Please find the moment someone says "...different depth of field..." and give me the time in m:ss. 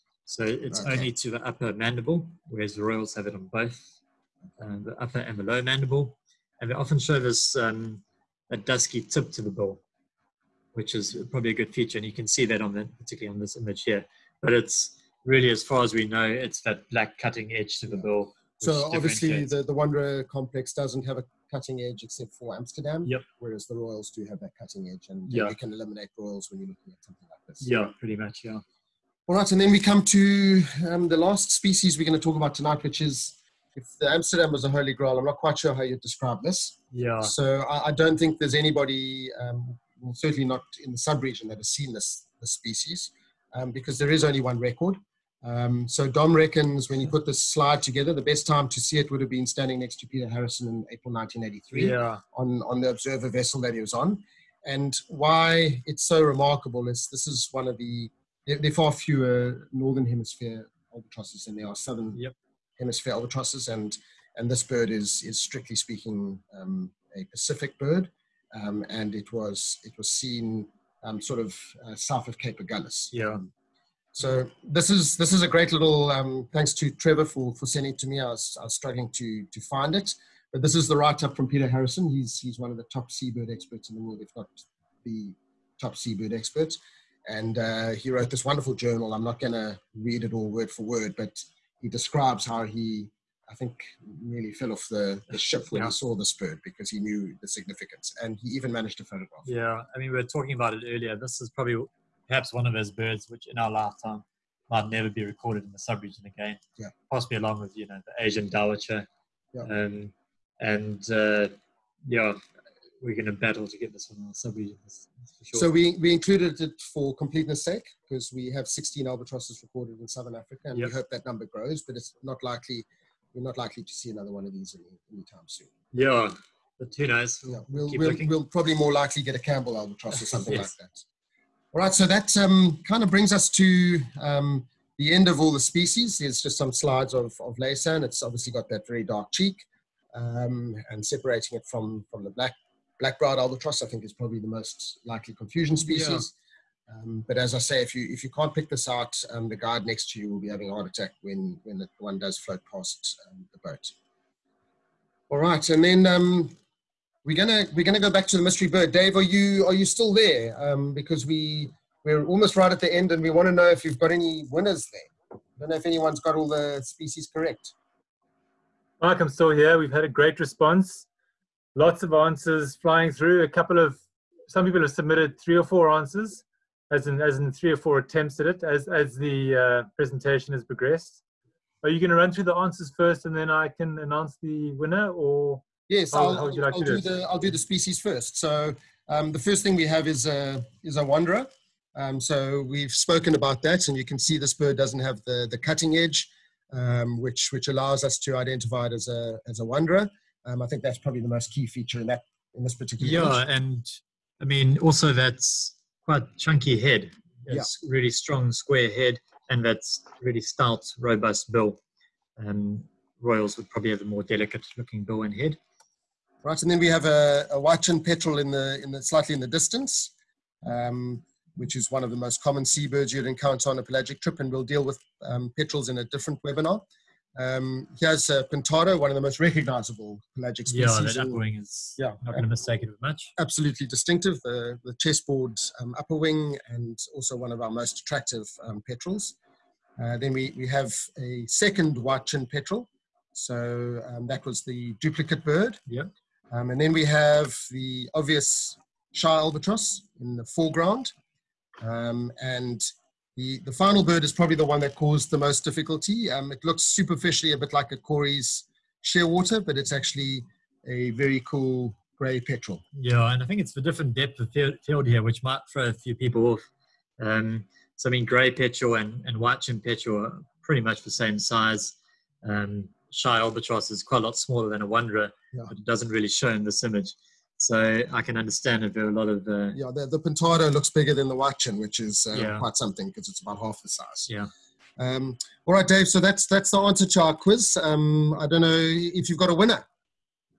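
4:23.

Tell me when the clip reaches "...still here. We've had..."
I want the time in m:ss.
2:49.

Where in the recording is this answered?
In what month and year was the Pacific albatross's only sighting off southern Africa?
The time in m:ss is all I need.
0:50.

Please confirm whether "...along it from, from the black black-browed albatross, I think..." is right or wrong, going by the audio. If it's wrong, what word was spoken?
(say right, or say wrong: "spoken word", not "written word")
wrong: "separating", not "along".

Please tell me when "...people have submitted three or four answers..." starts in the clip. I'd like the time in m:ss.
2:54.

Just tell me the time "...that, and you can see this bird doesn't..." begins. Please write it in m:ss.
3:13.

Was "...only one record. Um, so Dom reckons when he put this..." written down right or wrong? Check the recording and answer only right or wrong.
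right.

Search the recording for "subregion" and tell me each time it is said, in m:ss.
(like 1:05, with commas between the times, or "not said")
1:45, 1:54.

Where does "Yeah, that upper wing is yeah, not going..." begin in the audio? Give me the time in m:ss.
3:50.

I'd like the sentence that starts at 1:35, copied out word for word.
he saw this bird because he knew the significance.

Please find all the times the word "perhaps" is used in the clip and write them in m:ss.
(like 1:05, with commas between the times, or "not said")
1:42.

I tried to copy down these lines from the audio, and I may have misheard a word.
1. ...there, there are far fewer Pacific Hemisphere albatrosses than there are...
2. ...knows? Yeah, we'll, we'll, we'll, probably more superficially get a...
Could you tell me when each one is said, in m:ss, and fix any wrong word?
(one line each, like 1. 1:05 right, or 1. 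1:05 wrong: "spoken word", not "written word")
1. 0:58 wrong: "Northern", not "Pacific"
2. 2:07 wrong: "likely", not "superficially".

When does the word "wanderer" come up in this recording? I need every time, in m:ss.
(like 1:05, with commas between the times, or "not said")
0:19, 3:11, 3:19, 4:34.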